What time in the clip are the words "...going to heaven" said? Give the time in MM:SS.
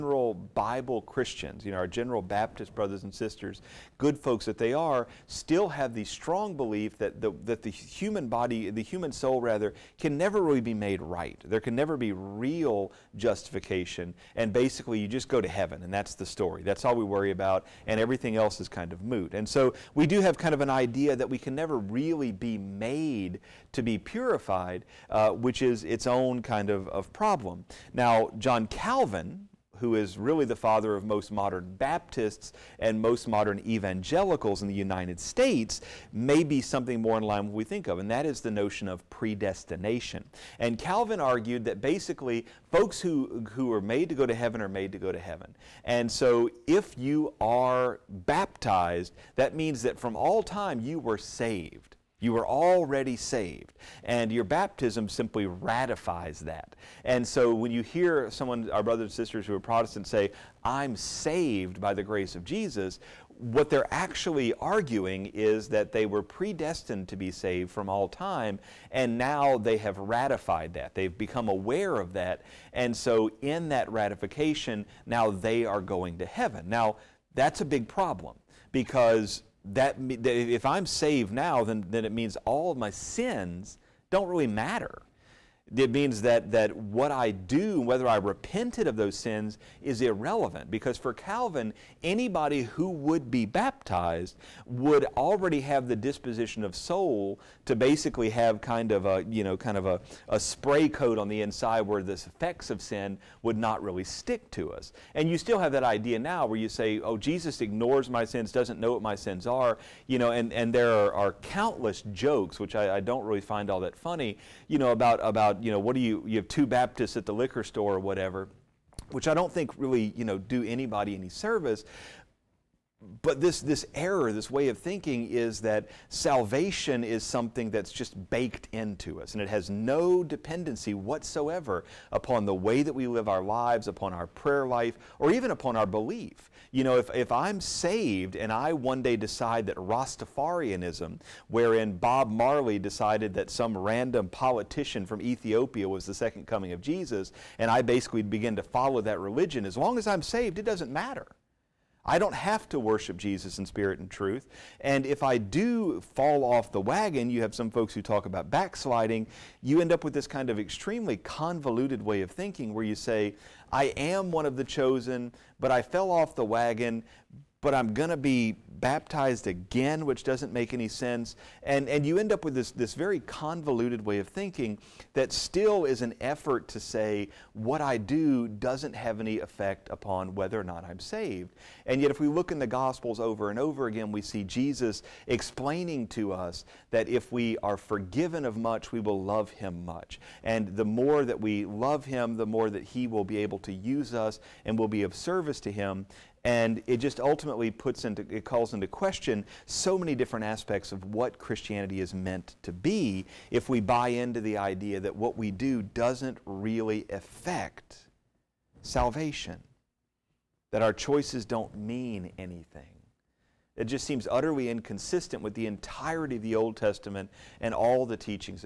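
01:15.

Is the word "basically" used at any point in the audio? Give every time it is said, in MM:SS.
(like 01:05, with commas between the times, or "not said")
00:14, 00:41, 01:37, 02:27.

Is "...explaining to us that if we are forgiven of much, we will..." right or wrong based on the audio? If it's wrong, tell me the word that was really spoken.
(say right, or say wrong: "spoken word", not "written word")
right.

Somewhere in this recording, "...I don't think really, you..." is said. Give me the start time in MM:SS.
01:59.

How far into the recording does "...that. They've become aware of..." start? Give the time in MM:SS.
01:10.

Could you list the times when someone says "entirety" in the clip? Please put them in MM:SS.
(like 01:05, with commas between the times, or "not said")
03:35.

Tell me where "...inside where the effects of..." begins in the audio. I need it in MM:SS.
01:41.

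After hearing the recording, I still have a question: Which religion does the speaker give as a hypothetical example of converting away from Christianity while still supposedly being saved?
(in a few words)
Rastafarianism.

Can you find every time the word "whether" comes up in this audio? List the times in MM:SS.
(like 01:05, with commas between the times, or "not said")
01:27, 03:00.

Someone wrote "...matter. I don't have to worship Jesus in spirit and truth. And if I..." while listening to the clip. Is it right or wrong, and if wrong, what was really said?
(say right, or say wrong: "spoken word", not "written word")
right.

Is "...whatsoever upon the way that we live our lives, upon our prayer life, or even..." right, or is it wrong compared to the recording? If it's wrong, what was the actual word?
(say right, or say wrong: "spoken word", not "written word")
right.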